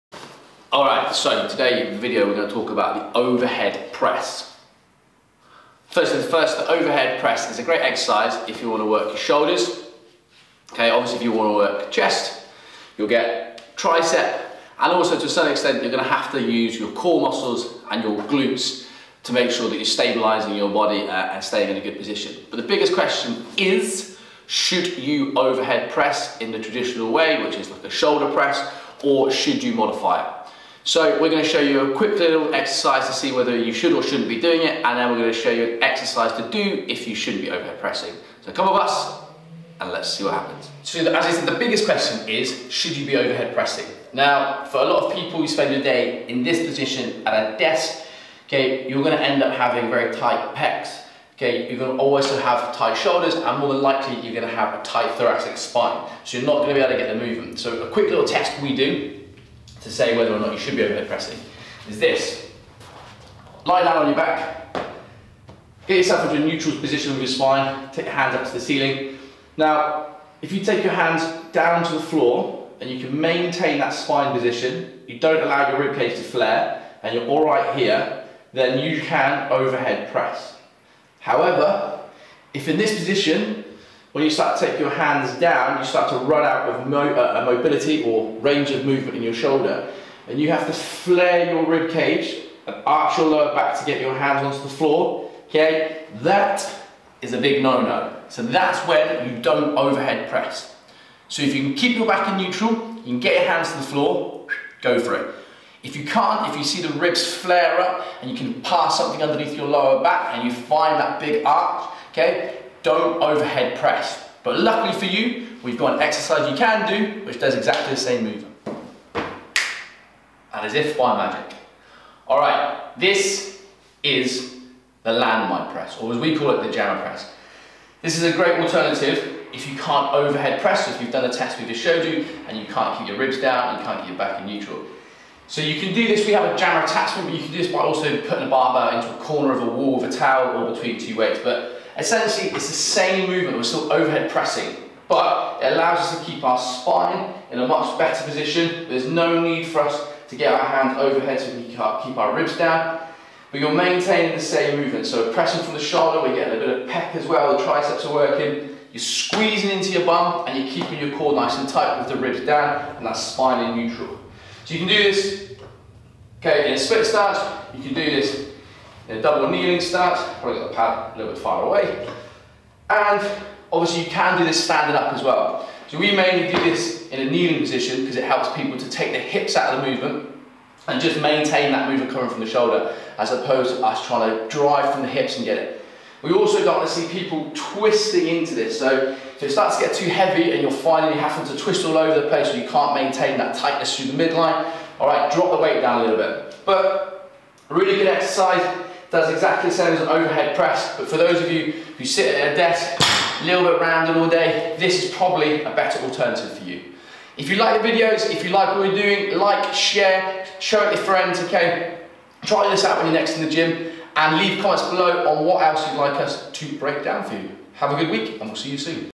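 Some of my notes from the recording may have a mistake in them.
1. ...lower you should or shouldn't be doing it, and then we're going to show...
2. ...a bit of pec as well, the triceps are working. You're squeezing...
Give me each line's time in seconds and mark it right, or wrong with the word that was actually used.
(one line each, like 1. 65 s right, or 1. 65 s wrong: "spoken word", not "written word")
1. 33 s wrong: "whether", not "lower"
2. 156 s right.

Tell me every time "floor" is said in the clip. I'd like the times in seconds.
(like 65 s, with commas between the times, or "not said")
71 s, 94 s, 103 s.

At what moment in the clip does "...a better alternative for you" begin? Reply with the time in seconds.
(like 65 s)
205 s.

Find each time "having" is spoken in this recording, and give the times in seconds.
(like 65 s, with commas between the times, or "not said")
49 s, 191 s.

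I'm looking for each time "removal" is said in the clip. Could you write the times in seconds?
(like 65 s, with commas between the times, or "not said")
not said.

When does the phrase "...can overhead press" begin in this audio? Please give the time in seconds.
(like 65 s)
79 s.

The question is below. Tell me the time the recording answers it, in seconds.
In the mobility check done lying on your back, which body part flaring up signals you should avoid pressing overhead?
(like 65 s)
91 s.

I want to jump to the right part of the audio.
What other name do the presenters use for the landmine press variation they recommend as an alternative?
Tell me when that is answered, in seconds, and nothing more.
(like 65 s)
126 s.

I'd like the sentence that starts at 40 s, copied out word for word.
So as I said, the biggest question is, should you be overhead pressing?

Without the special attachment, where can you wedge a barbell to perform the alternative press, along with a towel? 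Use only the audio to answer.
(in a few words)
a corner of a wall.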